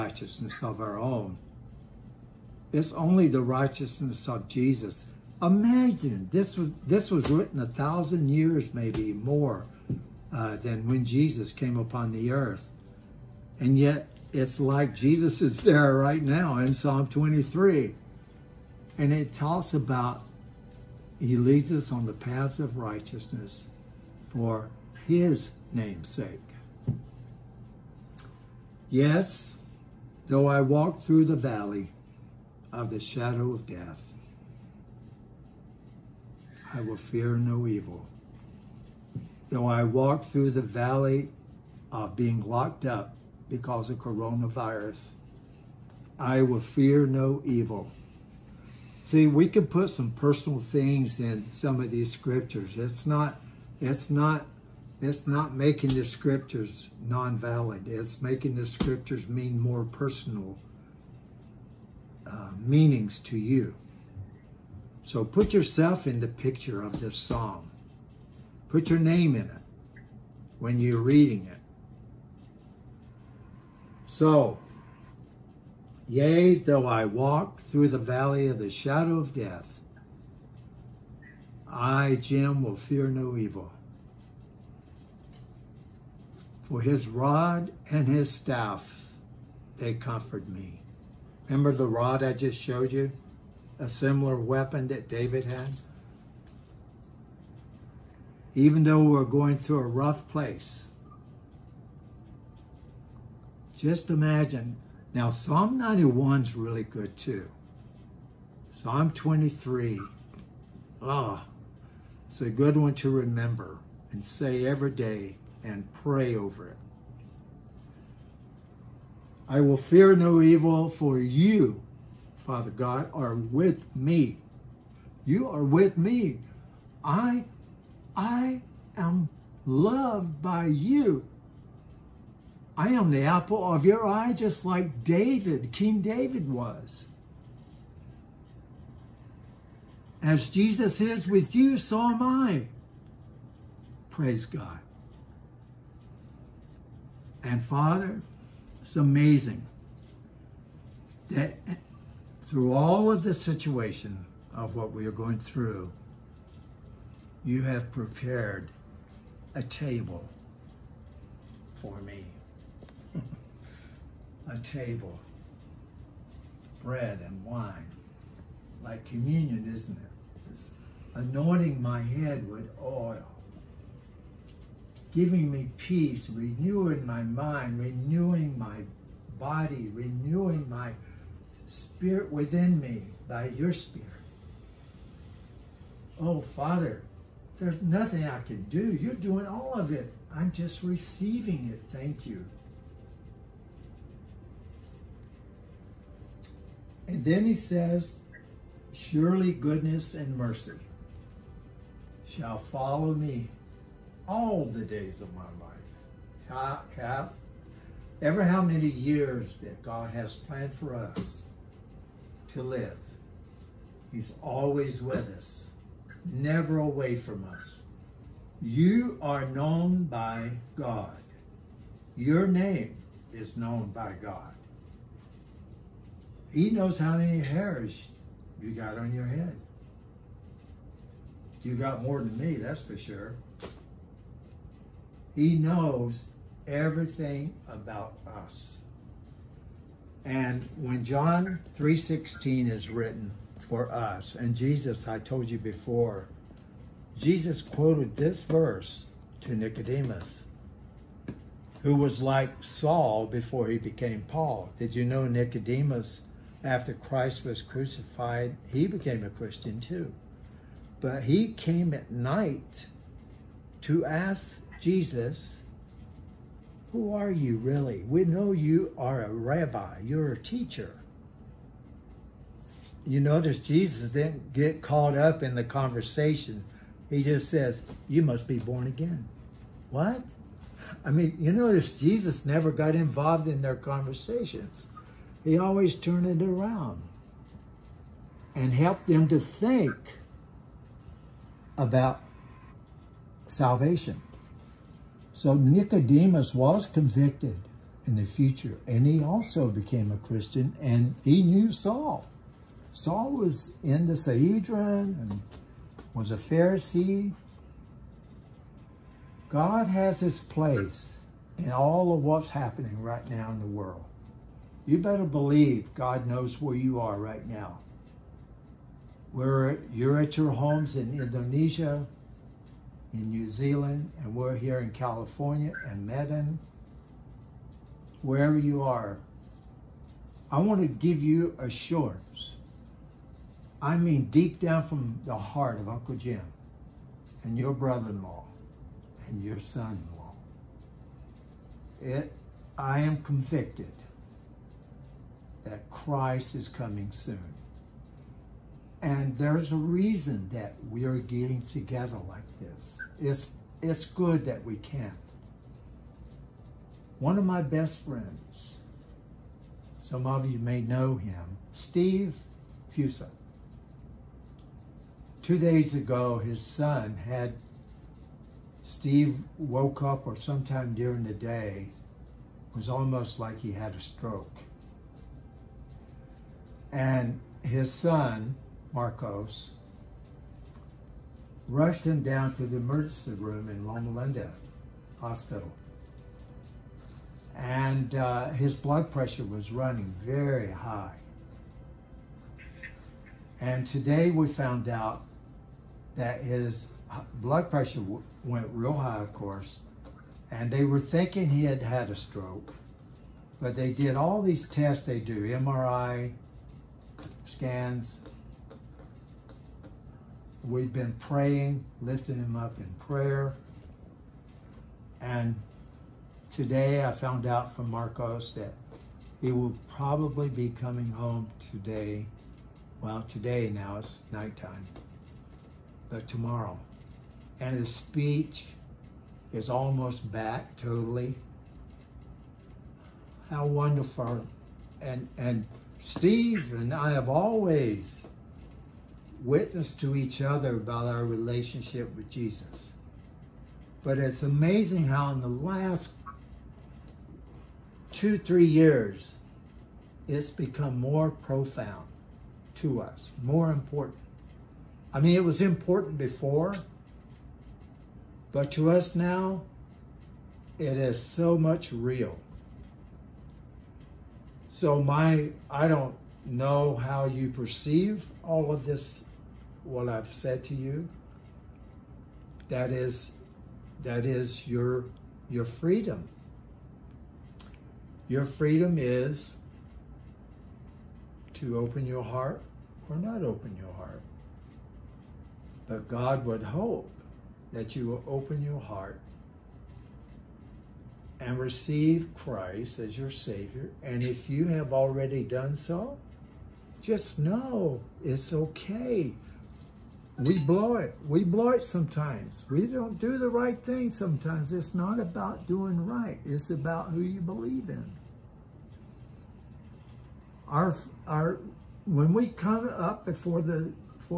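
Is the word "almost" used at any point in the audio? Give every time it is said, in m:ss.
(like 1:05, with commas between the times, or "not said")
6:12, 7:09.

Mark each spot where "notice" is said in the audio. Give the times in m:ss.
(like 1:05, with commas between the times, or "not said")
4:33, 4:41.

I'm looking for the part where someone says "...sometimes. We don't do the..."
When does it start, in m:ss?
8:21.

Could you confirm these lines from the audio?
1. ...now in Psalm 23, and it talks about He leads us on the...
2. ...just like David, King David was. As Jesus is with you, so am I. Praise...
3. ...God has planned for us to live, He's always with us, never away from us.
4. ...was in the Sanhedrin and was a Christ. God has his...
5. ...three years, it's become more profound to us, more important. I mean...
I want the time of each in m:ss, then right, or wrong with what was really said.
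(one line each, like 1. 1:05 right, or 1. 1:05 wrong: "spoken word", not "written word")
1. 0:16 right
2. 2:14 right
3. 3:29 right
4. 5:03 wrong: "Pharisee", not "Christ"
5. 7:28 right.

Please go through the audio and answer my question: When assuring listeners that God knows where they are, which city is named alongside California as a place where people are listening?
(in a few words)
Medan.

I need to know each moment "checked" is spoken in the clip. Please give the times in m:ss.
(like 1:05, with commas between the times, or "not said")
not said.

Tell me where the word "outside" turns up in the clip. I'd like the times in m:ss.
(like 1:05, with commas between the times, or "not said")
not said.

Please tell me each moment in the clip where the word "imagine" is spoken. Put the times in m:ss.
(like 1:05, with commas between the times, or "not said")
0:05, 1:44.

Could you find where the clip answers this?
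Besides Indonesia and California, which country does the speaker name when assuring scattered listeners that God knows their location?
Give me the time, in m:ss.
5:23.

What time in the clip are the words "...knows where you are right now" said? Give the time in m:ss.
5:16.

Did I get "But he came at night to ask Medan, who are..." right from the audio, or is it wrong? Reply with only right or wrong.
wrong.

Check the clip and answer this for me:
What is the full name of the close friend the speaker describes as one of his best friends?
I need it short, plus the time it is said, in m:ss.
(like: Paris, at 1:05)
Steve Fusa, at 6:01.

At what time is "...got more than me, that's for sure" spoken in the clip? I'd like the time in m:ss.
3:51.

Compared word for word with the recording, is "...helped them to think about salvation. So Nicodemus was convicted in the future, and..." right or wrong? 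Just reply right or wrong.
right.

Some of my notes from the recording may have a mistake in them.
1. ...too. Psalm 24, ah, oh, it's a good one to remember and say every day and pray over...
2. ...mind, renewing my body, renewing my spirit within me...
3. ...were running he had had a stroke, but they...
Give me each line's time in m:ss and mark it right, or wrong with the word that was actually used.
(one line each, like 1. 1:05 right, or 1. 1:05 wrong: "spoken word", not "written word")
1. 1:47 wrong: "23", not "24"
2. 2:57 right
3. 6:40 wrong: "thinking", not "running".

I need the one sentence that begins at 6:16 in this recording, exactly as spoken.
And his son, Marcos, rushed him down to the emergency room in Loma Linda Hospital.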